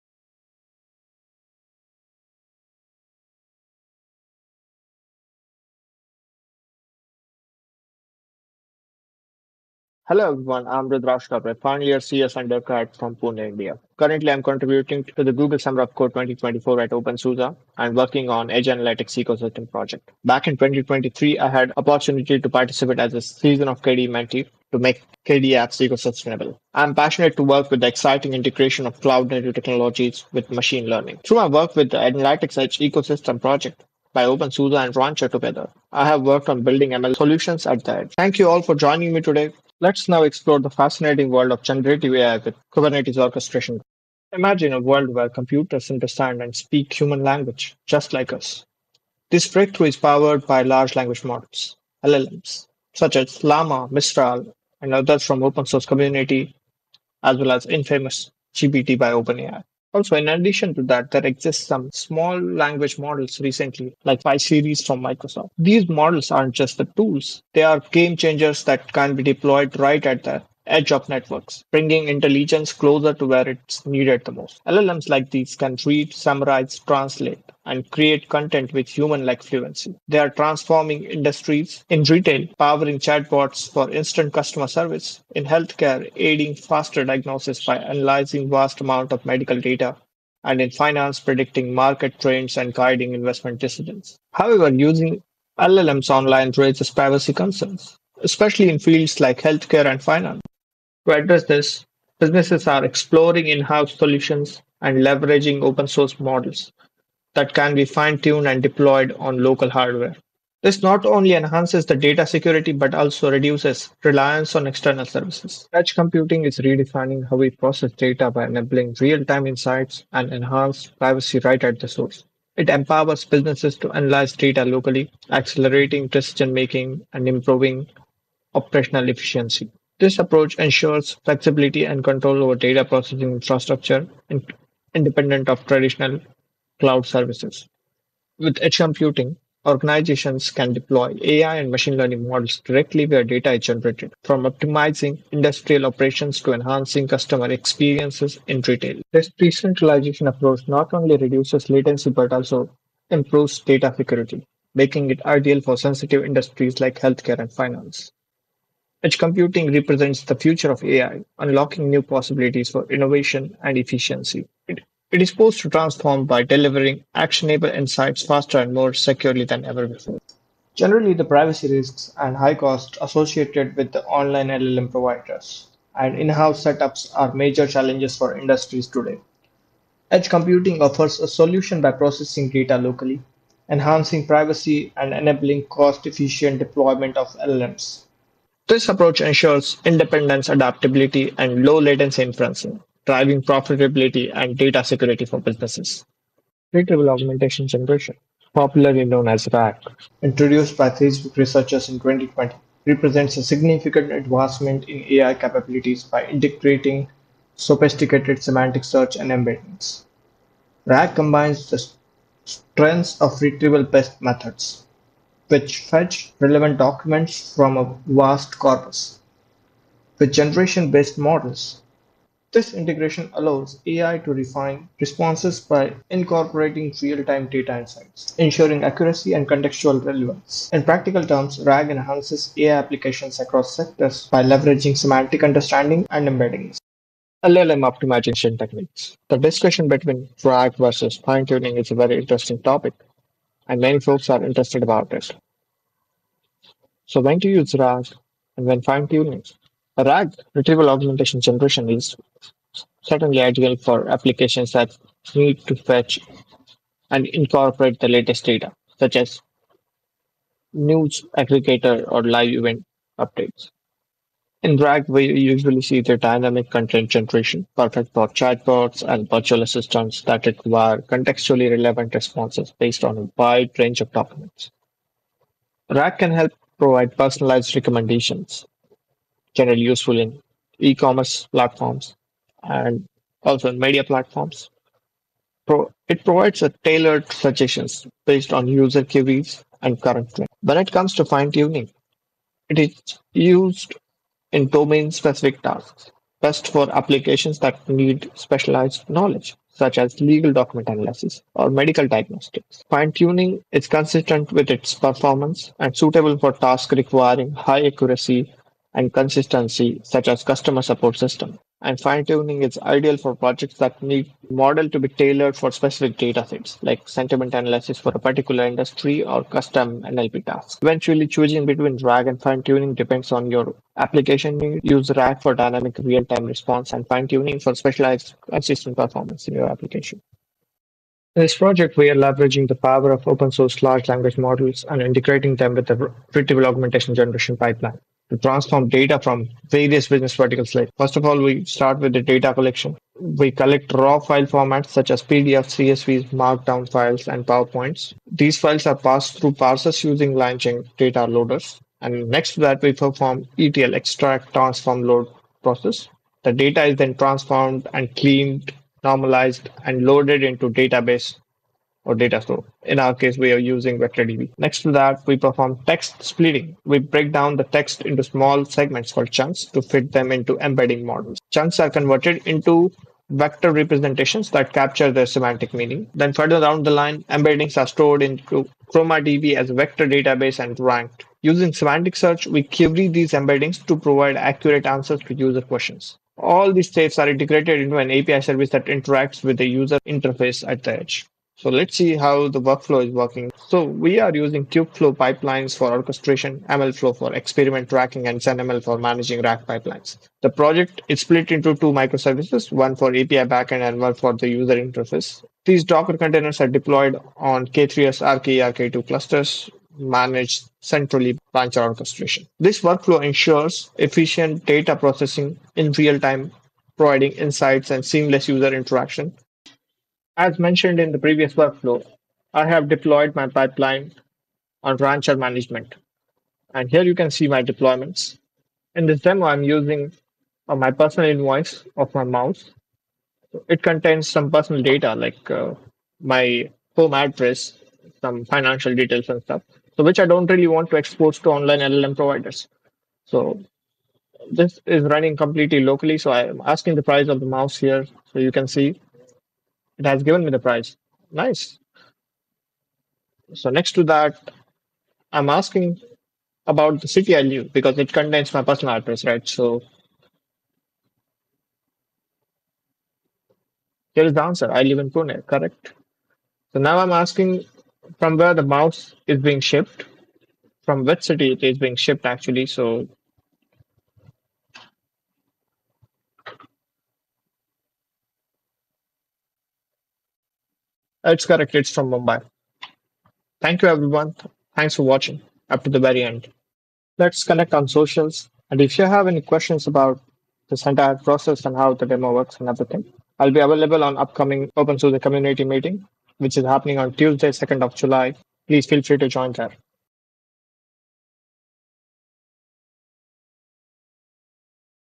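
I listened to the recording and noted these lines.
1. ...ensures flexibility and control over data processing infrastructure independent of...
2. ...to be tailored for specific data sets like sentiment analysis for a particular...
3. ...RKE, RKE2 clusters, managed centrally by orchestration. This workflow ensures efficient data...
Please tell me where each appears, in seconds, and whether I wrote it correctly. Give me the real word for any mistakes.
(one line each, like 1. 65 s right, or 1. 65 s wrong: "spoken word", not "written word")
1. 130 s right
2. 314 s right
3. 408 s right.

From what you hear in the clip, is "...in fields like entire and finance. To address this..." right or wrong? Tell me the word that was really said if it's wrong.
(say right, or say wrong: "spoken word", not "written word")
wrong: "healthcare", not "entire".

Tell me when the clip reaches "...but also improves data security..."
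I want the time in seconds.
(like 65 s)
152 s.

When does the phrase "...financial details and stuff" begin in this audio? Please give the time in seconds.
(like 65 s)
438 s.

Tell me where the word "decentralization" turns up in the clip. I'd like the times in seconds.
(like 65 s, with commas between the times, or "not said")
149 s.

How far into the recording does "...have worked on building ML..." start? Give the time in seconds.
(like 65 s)
36 s.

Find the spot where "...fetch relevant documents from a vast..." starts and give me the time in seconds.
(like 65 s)
215 s.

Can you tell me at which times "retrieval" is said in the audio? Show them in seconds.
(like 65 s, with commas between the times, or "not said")
196 s, 213 s, 250 s, 336 s.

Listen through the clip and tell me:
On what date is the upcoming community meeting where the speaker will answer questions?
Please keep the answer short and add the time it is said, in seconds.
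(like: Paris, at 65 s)
2 July, at 497 s.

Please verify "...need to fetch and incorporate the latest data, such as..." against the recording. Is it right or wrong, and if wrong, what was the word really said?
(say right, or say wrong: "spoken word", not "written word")
right.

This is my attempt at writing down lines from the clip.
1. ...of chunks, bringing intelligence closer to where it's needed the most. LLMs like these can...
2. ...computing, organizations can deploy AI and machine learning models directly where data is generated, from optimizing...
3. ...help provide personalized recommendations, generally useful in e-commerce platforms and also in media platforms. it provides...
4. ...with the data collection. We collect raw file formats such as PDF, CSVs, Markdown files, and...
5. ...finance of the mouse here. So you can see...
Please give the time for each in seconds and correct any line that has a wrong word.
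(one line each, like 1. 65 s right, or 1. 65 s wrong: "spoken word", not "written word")
1. 70 s wrong: "networks", not "chunks"
2. 138 s right
3. 276 s right
4. 341 s right
5. 447 s wrong: "price", not "finance".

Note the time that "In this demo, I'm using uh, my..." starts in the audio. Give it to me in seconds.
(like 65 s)
428 s.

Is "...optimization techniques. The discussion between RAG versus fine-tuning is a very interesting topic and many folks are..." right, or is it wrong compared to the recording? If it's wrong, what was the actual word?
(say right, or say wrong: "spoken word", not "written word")
right.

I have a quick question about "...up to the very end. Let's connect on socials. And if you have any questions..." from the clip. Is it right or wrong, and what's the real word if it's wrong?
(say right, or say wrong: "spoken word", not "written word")
right.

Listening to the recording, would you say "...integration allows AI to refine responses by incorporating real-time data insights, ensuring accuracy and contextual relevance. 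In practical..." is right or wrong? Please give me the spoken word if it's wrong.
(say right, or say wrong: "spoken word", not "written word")
right.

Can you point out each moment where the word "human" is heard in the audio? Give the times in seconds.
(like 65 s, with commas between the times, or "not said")
46 s, 78 s.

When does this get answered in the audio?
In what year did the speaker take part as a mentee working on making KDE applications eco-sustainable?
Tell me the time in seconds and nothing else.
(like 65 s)
20 s.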